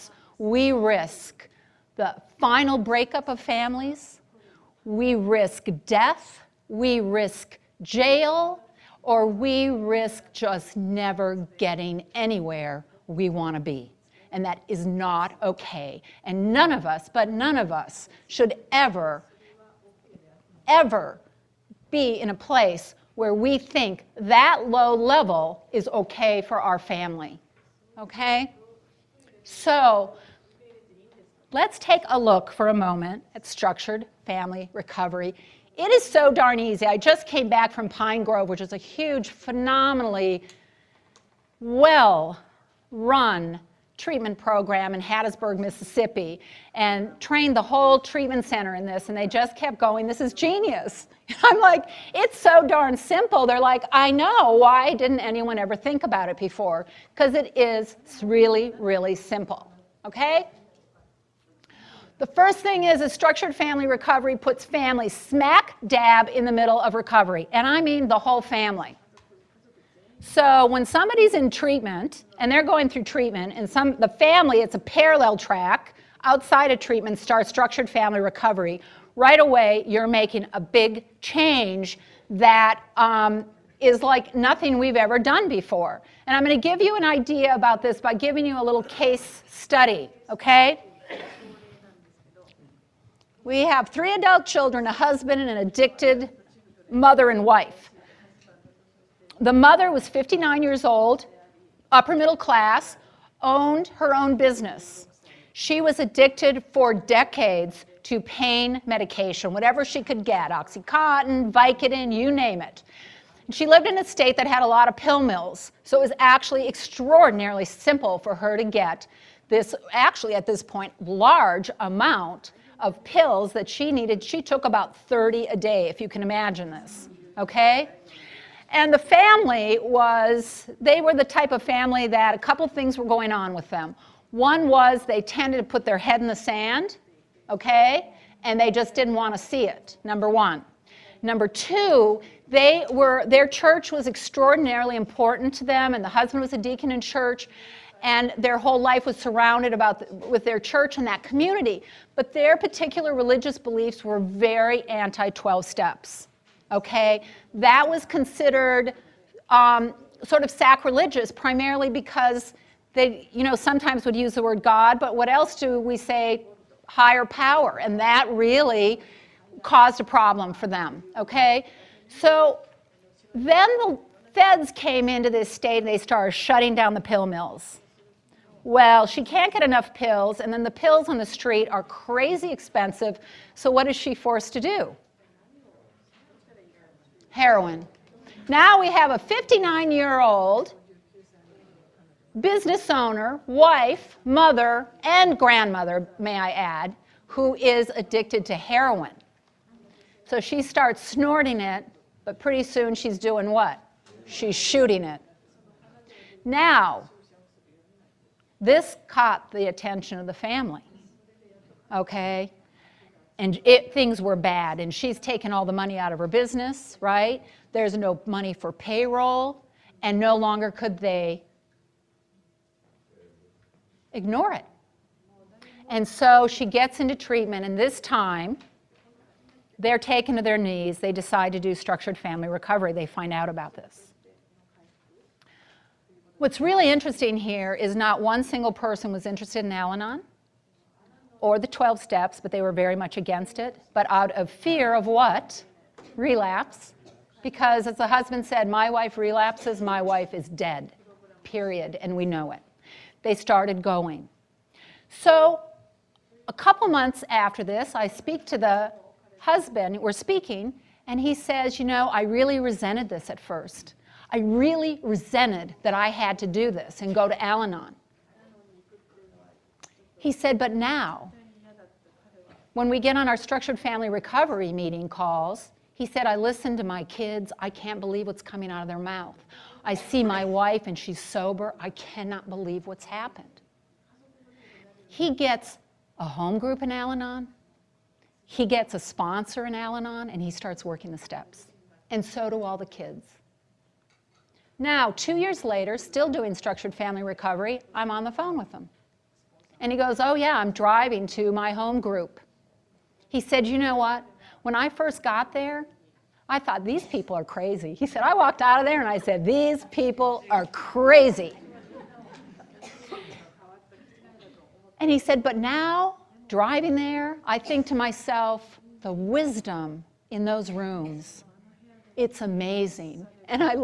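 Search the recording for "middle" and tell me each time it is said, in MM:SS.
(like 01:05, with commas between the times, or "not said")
01:06, 01:42.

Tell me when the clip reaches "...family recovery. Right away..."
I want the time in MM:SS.
01:17.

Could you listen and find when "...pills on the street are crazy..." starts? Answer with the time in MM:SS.
03:00.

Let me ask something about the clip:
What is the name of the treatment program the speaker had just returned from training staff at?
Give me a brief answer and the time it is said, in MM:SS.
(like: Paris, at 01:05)
Pine Grove, at 00:37.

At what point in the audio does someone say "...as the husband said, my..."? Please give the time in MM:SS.
04:07.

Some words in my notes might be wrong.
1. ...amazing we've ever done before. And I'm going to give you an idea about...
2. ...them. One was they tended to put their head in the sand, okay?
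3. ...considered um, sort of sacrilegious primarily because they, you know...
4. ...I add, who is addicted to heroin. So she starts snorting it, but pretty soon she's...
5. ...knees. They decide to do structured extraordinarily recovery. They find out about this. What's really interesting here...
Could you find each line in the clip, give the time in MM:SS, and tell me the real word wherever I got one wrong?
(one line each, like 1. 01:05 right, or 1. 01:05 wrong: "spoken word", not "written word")
1. 01:24 wrong: "nothing", not "amazing"
2. 02:13 right
3. 02:38 right
4. 03:16 right
5. 03:50 wrong: "family", not "extraordinarily".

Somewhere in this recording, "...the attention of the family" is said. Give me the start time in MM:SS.
03:29.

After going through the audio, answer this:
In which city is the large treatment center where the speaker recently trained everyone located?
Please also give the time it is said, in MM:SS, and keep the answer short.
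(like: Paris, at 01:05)
Hattiesburg, Mississippi, at 00:45.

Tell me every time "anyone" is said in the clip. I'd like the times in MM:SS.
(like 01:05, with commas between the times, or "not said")
00:55.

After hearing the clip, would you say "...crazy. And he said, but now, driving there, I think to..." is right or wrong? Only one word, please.
right.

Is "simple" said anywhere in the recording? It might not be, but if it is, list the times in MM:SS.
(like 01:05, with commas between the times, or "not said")
00:52, 00:59, 01:57.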